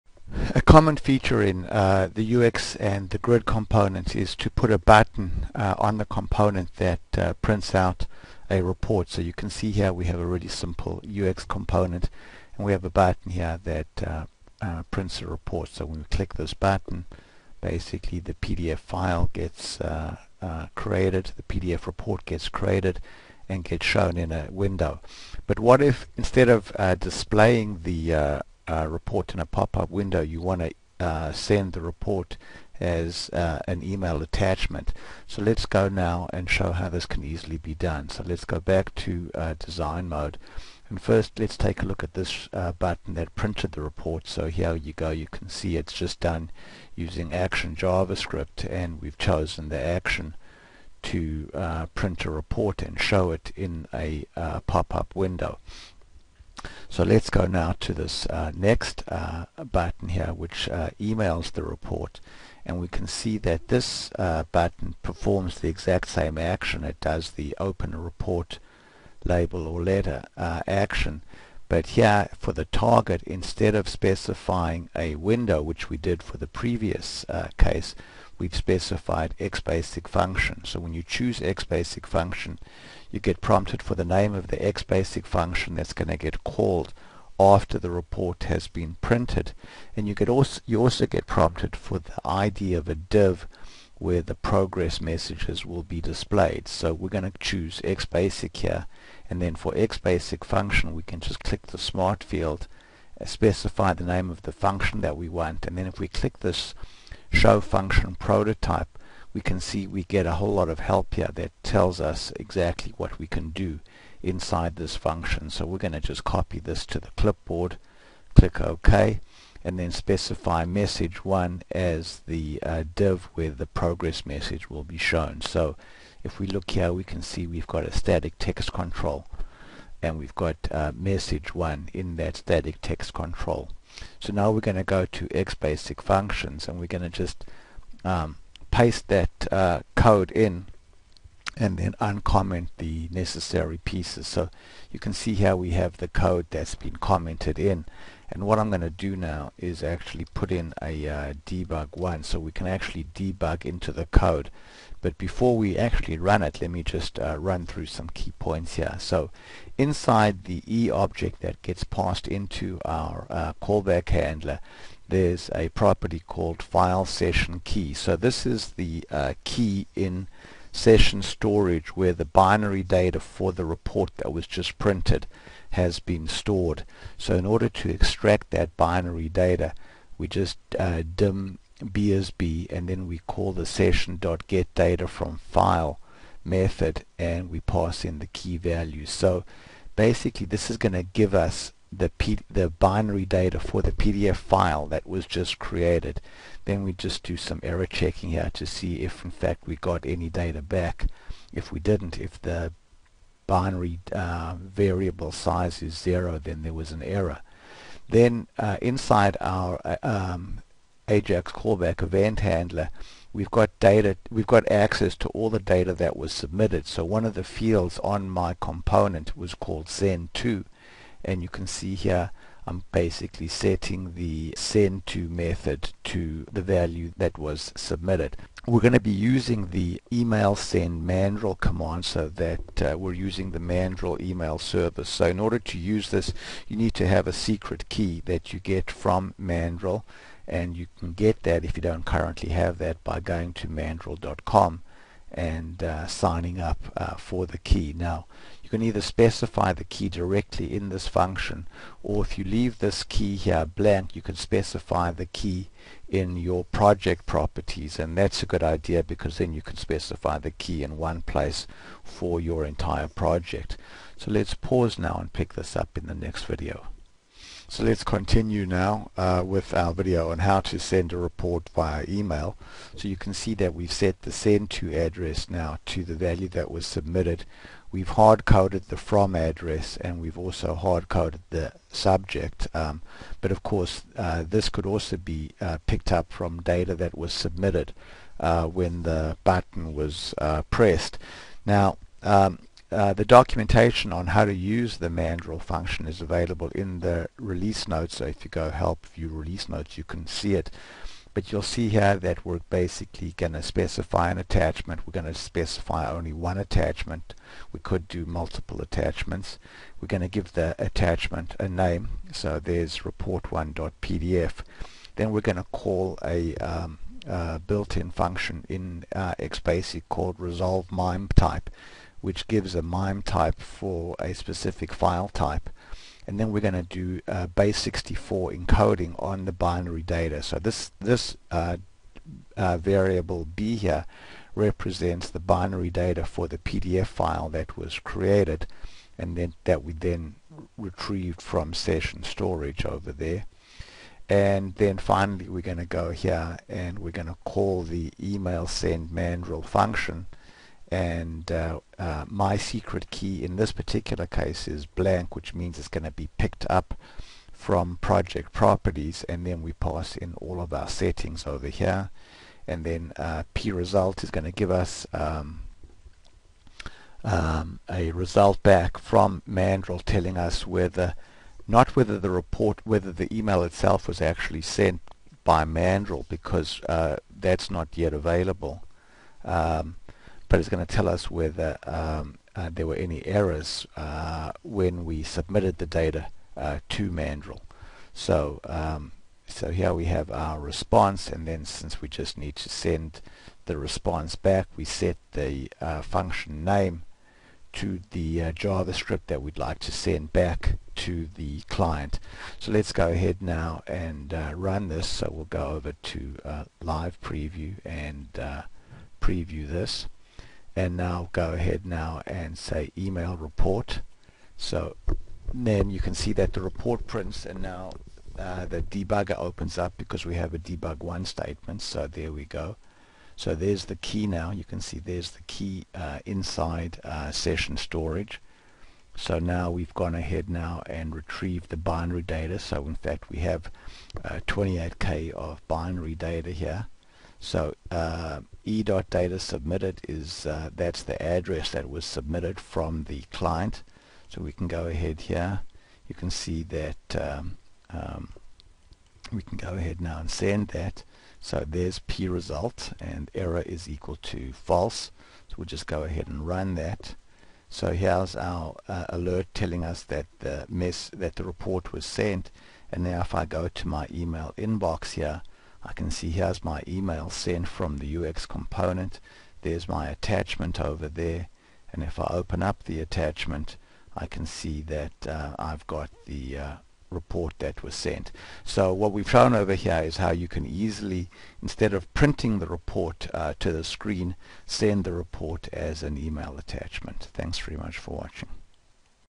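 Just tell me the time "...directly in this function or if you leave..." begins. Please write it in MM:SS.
04:10.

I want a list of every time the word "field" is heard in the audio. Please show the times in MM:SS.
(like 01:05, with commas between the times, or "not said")
01:42, 03:37.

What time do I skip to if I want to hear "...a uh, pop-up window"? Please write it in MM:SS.
00:53.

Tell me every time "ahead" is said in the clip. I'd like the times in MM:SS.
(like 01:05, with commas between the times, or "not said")
06:43, 06:51, 07:10, 07:24, 07:29, 07:36.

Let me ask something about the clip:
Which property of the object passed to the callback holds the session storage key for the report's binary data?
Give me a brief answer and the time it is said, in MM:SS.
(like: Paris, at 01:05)
file session key, at 02:46.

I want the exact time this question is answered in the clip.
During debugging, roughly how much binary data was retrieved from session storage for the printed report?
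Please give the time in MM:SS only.
07:14.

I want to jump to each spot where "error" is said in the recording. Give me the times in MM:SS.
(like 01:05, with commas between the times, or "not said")
03:17, 03:27, 06:23, 07:33.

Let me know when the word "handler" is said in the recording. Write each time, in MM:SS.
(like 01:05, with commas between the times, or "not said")
02:44, 03:32.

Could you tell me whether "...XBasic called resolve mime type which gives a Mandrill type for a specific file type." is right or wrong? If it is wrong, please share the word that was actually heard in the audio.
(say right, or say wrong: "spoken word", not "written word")
wrong: "MIME", not "Mandrill".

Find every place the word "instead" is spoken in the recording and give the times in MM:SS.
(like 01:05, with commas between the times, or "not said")
00:26, 01:13, 08:01.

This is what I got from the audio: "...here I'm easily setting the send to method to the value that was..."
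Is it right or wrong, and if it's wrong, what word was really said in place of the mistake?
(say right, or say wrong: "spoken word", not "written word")
wrong: "basically", not "easily".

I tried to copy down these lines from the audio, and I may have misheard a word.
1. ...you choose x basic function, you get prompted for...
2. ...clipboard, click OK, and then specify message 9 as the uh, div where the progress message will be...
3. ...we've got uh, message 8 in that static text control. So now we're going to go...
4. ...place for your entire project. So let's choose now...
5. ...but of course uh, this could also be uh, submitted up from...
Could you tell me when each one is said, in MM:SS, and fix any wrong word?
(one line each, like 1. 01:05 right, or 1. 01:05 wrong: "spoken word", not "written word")
1. 01:20 right
2. 01:57 wrong: "1", not "9"
3. 02:10 wrong: "1", not "8"
4. 04:21 wrong: "pause", not "choose"
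5. 04:43 wrong: "picked", not "submitted".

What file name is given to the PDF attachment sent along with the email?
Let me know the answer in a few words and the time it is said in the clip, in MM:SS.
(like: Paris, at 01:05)
report1.pdf, at 05:12.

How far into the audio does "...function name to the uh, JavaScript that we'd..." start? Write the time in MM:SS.
06:36.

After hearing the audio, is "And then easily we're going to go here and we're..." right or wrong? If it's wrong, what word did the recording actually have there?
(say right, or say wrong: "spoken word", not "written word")
wrong: "finally", not "easily".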